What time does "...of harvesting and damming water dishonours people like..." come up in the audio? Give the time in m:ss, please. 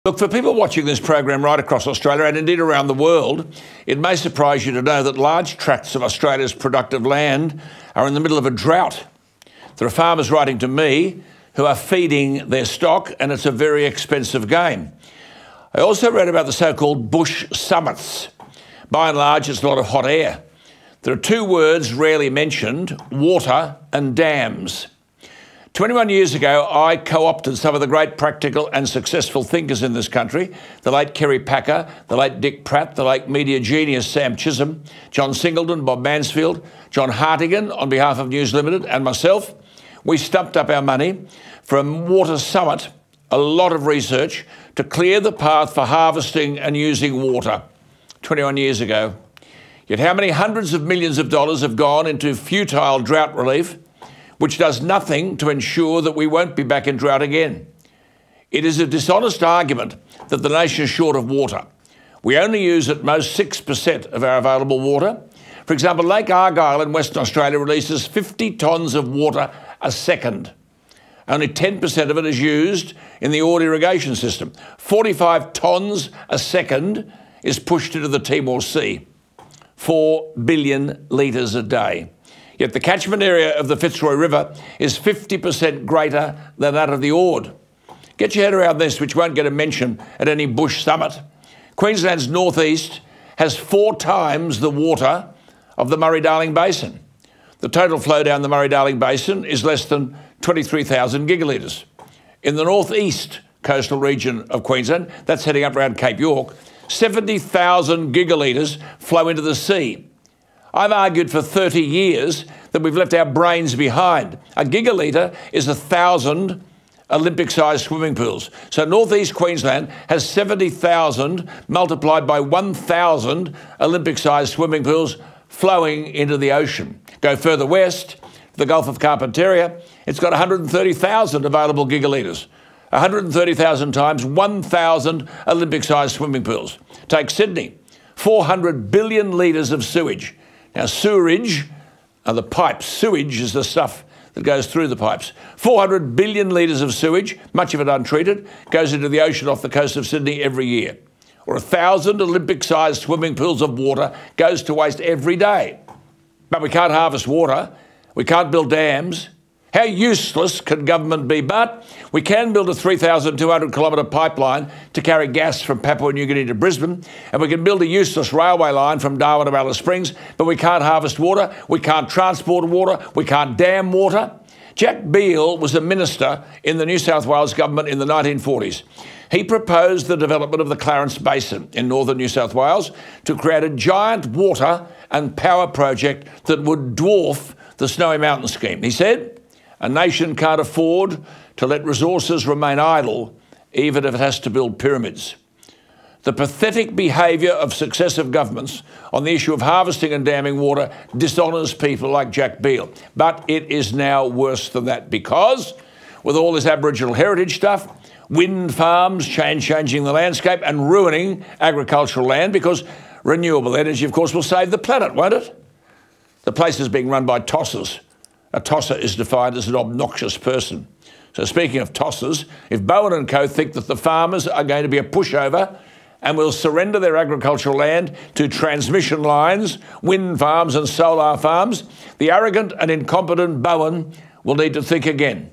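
3:19.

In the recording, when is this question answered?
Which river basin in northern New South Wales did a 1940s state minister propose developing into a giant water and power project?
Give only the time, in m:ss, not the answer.
3:00.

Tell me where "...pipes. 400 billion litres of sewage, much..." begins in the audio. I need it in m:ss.
2:24.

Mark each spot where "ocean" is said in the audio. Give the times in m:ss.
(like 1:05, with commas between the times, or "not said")
2:06, 2:29.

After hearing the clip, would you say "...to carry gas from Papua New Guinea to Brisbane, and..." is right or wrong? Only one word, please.
right.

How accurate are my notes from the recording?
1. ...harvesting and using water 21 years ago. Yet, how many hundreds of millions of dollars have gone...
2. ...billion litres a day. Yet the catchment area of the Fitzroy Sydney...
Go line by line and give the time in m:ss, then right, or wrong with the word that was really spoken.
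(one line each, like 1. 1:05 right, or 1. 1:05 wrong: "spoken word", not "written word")
1. 0:45 right
2. 1:20 wrong: "River", not "Sydney".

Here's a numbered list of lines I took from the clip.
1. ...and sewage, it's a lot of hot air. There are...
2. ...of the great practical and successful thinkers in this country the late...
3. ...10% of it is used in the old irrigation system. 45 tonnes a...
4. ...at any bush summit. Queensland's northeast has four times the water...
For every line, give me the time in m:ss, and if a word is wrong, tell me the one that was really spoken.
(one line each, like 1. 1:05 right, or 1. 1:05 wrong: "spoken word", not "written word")
1. 0:19 wrong: "large", not "sewage"
2. 0:27 right
3. 1:11 right
4. 1:30 right.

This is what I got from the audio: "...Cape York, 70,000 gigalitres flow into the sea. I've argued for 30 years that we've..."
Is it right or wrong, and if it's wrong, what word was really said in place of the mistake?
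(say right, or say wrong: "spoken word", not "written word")
right.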